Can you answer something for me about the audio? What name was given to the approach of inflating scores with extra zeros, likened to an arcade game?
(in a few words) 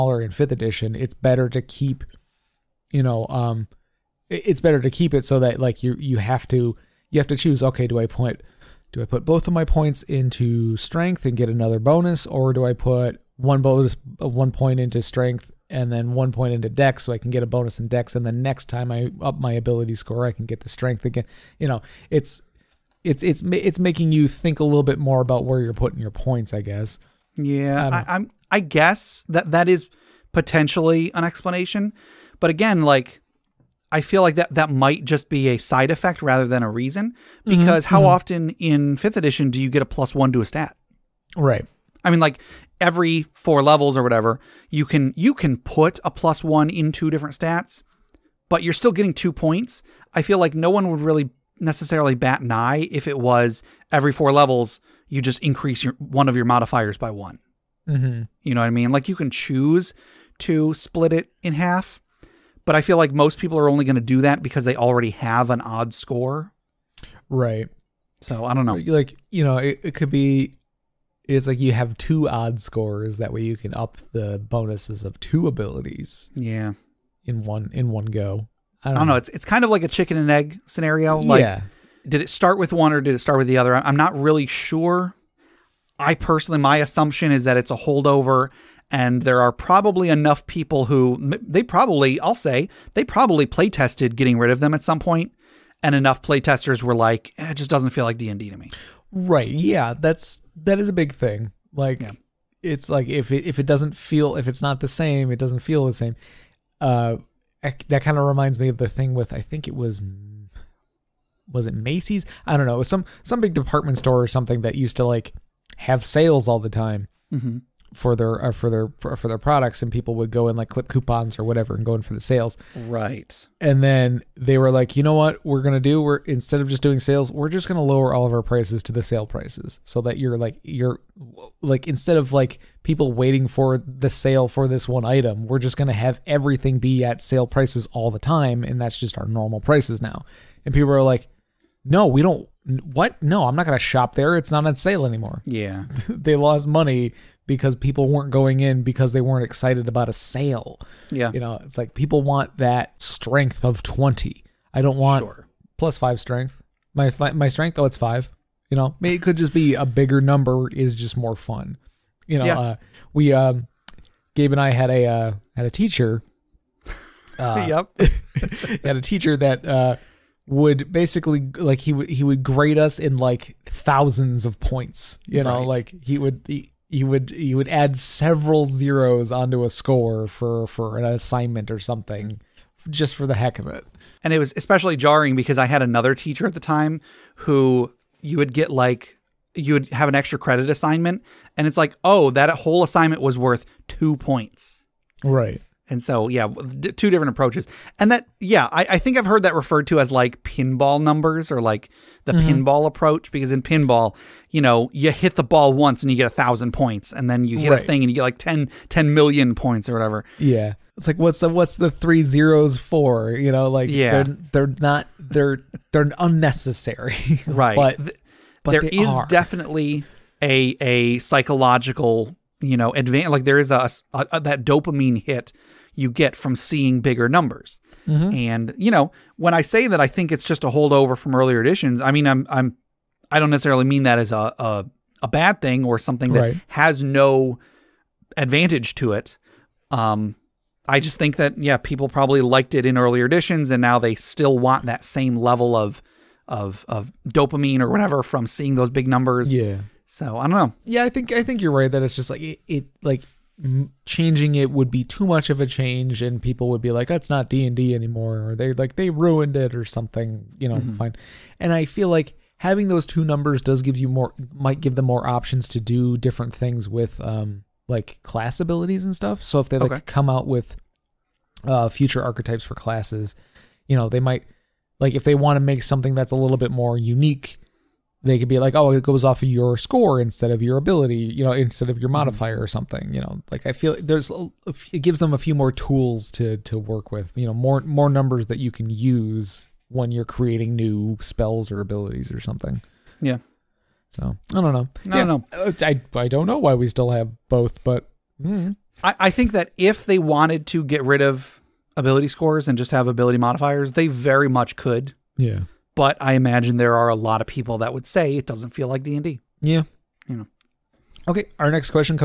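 pinball numbers.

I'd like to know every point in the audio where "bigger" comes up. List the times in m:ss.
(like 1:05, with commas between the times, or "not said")
2:39, 3:46.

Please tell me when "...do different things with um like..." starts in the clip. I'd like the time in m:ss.
4:25.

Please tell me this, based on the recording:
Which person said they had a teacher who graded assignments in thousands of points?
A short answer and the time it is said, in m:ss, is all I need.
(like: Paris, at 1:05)
Gabe, at 2:44.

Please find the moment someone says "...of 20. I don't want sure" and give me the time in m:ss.
2:33.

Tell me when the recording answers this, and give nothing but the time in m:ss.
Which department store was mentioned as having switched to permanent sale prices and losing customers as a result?
1:51.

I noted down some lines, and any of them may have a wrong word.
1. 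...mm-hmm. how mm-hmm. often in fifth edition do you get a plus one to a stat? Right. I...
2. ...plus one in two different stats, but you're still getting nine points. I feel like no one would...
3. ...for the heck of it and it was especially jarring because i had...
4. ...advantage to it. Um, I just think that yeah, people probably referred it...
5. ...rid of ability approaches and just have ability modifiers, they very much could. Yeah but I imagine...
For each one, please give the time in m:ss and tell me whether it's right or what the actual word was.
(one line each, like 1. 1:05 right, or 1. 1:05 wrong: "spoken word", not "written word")
1. 0:37 right
2. 0:46 wrong: "two", not "nine"
3. 3:03 right
4. 3:58 wrong: "liked", not "referred"
5. 5:01 wrong: "scores", not "approaches".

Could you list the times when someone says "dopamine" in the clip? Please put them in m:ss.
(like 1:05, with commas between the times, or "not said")
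3:44, 4:07.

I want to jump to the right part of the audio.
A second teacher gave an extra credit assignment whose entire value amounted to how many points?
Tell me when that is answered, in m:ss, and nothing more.
3:13.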